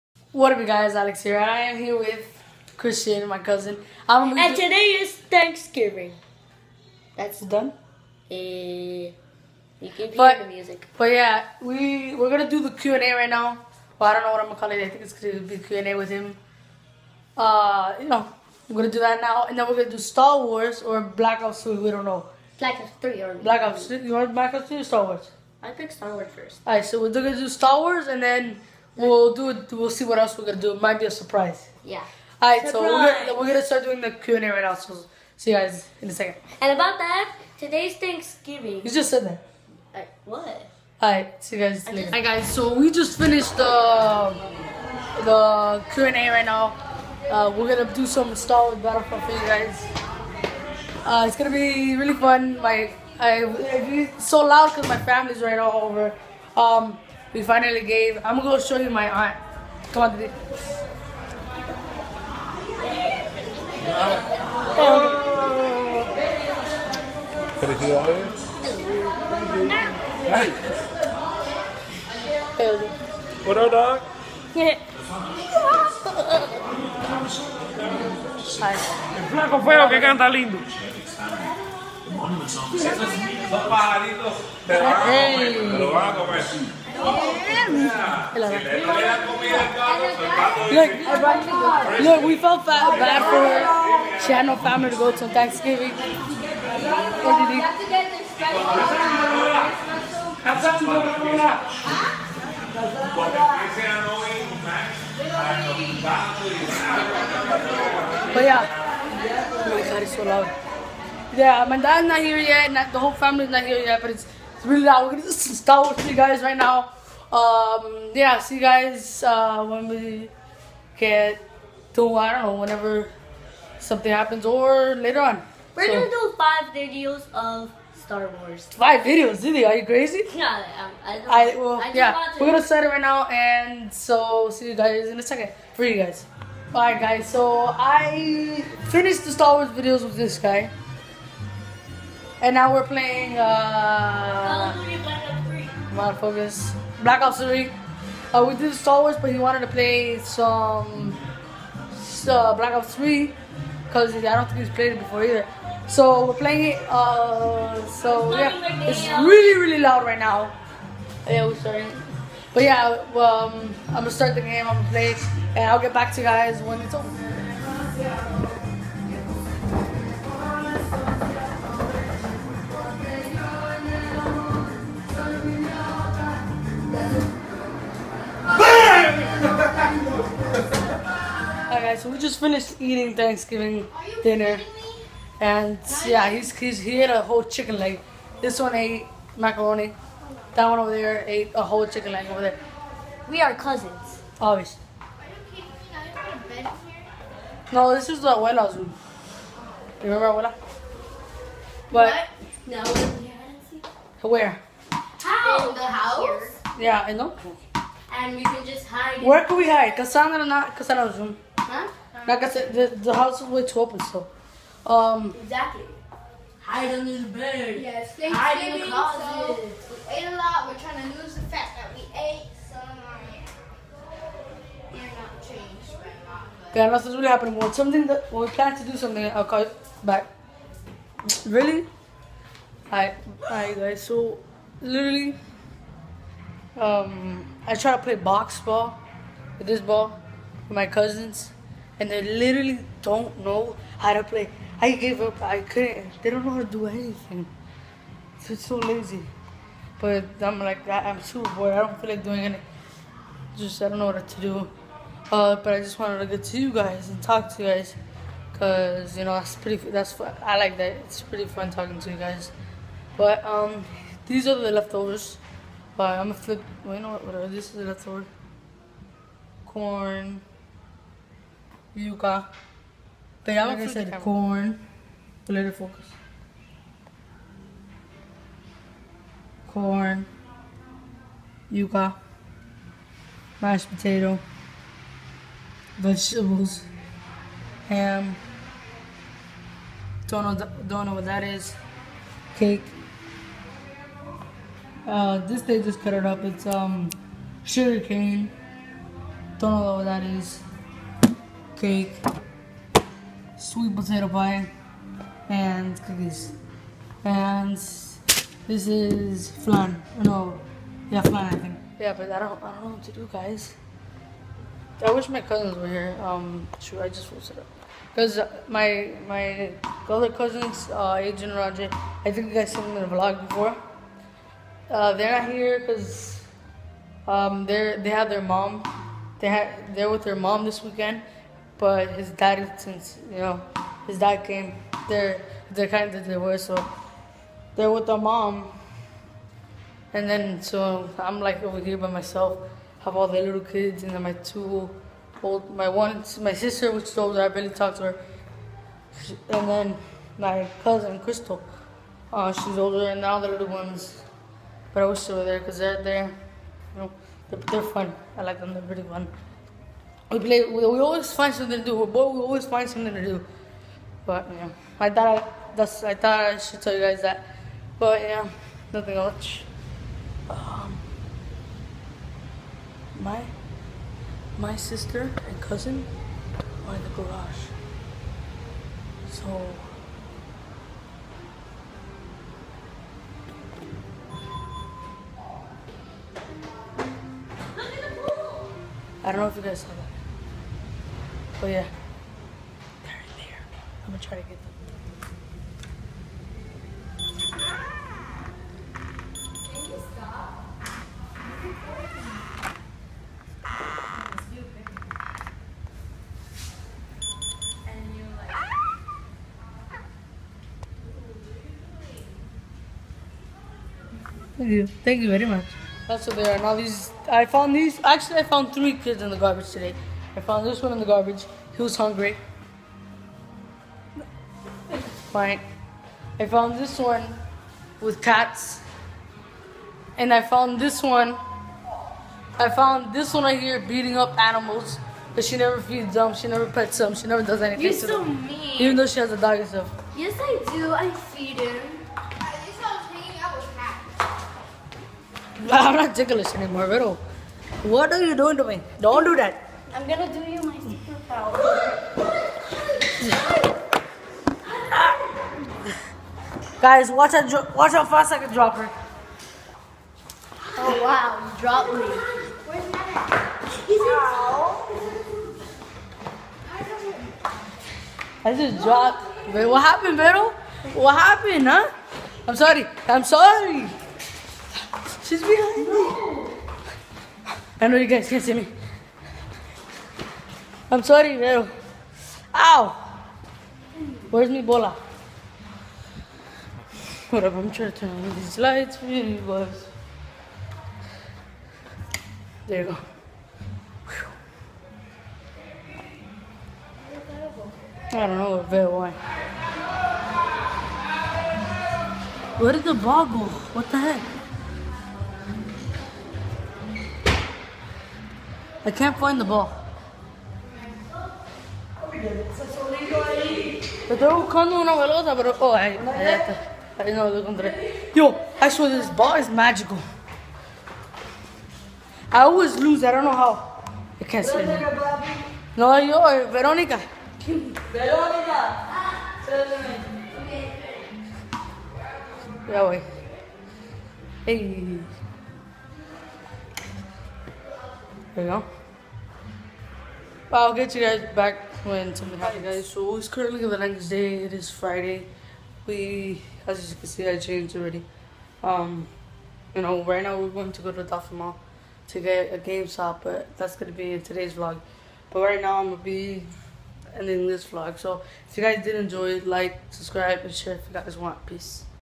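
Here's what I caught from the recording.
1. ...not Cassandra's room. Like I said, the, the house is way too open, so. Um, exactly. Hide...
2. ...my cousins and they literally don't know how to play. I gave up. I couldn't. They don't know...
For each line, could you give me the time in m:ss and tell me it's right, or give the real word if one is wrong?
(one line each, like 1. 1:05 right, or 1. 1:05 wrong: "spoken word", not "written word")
1. 3:30 right
2. 4:00 right.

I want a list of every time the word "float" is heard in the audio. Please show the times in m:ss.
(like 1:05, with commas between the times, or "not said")
not said.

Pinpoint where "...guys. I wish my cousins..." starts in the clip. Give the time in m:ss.
5:13.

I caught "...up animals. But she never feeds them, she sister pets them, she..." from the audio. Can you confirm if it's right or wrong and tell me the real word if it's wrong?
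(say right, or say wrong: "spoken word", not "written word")
wrong: "never", not "sister".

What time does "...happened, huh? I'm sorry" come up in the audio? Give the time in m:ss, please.
7:51.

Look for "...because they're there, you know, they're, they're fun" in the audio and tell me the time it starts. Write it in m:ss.
5:55.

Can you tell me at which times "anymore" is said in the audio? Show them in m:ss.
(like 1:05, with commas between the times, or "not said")
7:26.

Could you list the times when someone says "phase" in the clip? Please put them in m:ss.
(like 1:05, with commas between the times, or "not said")
not said.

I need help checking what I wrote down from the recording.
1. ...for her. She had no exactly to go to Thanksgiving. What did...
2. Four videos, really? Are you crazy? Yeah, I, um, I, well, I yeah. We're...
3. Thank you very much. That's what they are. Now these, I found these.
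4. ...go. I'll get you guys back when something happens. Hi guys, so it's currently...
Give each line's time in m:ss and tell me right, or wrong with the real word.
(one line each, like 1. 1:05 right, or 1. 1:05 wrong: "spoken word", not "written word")
1. 1:33 wrong: "family", not "exactly"
2. 2:08 wrong: "Five", not "Four"
3. 6:54 right
4. 8:58 right.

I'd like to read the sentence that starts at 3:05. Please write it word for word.
And yeah, he's, he's, he ate a whole chicken leg.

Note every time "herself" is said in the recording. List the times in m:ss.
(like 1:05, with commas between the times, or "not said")
7:19.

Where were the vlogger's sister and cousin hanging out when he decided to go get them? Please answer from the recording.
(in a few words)
the garage.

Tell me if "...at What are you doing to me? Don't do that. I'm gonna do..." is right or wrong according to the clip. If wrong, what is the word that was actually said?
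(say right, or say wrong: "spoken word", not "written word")
right.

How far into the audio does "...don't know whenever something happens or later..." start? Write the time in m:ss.
2:02.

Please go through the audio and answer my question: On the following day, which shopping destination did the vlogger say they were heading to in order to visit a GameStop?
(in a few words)
Dolphin Mall.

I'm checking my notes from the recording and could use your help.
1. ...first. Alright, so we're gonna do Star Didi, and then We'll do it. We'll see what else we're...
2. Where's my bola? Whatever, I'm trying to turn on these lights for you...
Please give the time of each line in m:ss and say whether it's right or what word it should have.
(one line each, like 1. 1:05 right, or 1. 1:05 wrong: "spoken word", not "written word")
1. 0:26 wrong: "Wars", not "Didi"
2. 8:04 right.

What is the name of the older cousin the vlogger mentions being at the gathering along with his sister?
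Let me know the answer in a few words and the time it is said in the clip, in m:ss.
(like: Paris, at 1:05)
Crystal, at 5:51.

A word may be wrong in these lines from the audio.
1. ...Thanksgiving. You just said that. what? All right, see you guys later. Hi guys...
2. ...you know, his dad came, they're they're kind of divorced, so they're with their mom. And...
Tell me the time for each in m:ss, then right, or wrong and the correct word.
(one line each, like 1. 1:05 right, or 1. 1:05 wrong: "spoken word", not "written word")
1. 0:37 right
2. 5:33 right.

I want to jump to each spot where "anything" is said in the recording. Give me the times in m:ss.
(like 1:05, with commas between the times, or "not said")
4:06, 4:12, 7:17.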